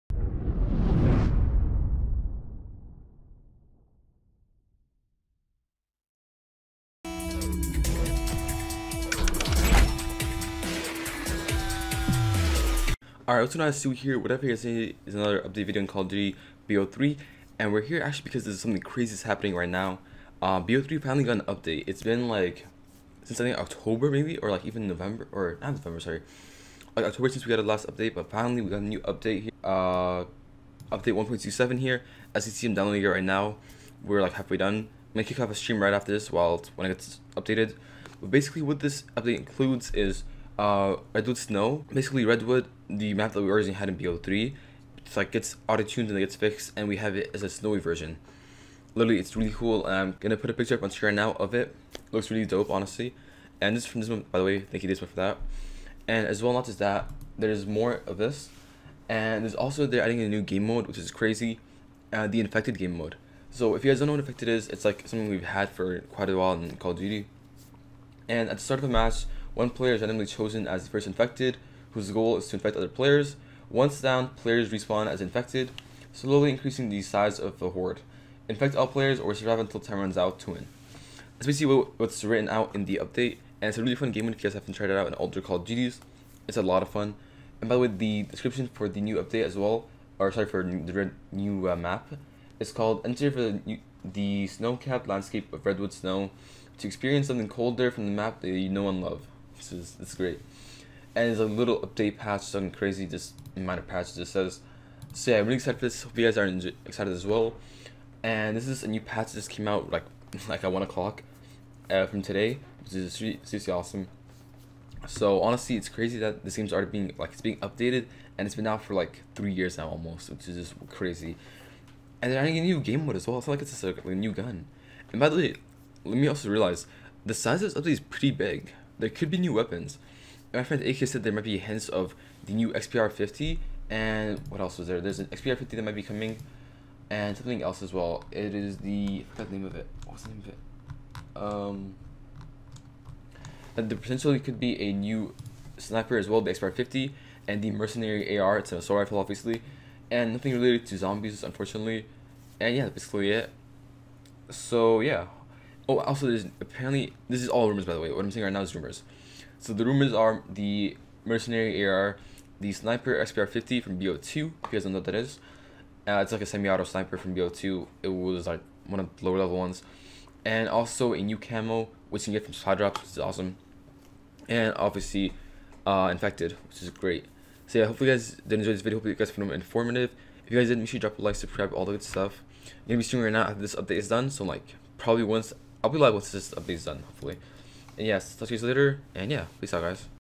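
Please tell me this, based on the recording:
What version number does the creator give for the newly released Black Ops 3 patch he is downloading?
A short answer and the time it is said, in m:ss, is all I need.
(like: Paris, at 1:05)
1.27, at 0:31.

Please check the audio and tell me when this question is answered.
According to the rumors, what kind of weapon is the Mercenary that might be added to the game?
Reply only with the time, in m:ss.
2:28.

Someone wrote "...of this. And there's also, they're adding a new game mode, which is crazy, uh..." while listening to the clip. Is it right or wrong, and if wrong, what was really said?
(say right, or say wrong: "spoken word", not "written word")
right.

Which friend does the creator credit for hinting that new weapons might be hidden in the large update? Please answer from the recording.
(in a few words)
AK.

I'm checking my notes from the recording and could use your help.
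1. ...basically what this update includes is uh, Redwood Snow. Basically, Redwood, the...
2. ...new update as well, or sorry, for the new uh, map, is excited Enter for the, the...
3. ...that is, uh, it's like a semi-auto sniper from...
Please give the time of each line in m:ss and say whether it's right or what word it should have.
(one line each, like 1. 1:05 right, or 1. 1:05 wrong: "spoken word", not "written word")
1. 0:38 right
2. 1:29 wrong: "called", not "excited"
3. 2:45 right.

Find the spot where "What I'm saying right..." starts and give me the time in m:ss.
2:38.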